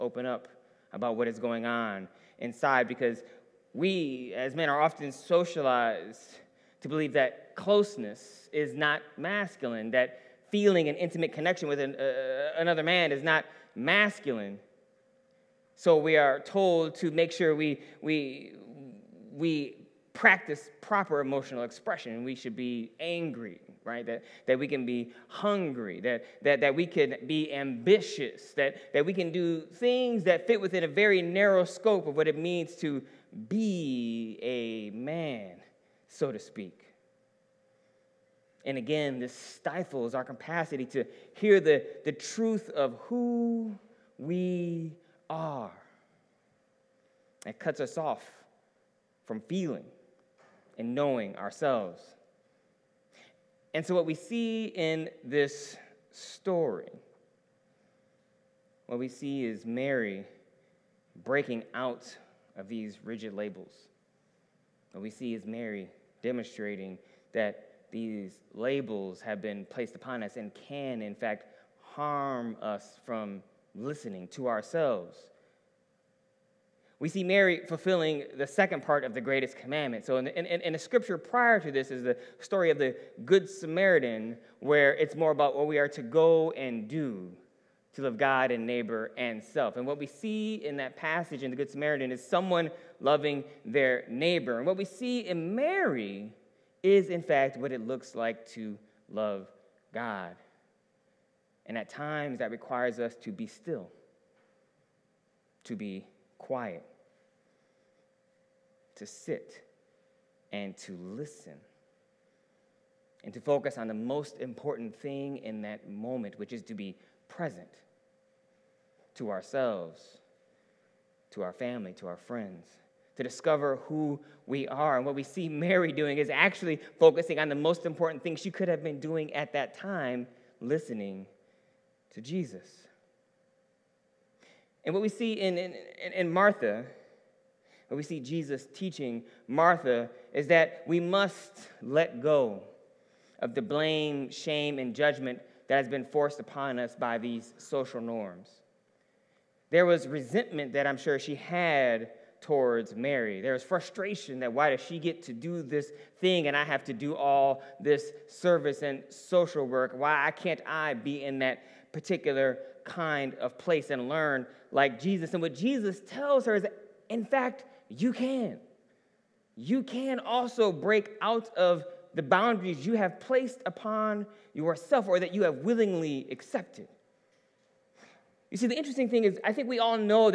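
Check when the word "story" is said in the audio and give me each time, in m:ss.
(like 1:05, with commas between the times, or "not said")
0:56, 1:22.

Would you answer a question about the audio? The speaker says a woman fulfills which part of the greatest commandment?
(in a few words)
The second part.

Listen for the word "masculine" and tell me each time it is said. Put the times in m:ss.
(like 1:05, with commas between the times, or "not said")
0:09, 0:13.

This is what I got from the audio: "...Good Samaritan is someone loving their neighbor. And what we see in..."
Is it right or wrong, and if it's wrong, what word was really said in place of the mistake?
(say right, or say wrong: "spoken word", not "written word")
right.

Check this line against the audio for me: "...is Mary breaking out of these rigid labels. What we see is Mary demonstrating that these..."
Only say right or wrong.
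right.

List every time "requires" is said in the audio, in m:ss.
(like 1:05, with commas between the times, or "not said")
1:42.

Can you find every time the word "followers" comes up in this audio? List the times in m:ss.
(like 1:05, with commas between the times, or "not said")
not said.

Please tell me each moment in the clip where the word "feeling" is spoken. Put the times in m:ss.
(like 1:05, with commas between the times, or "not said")
0:10, 0:49.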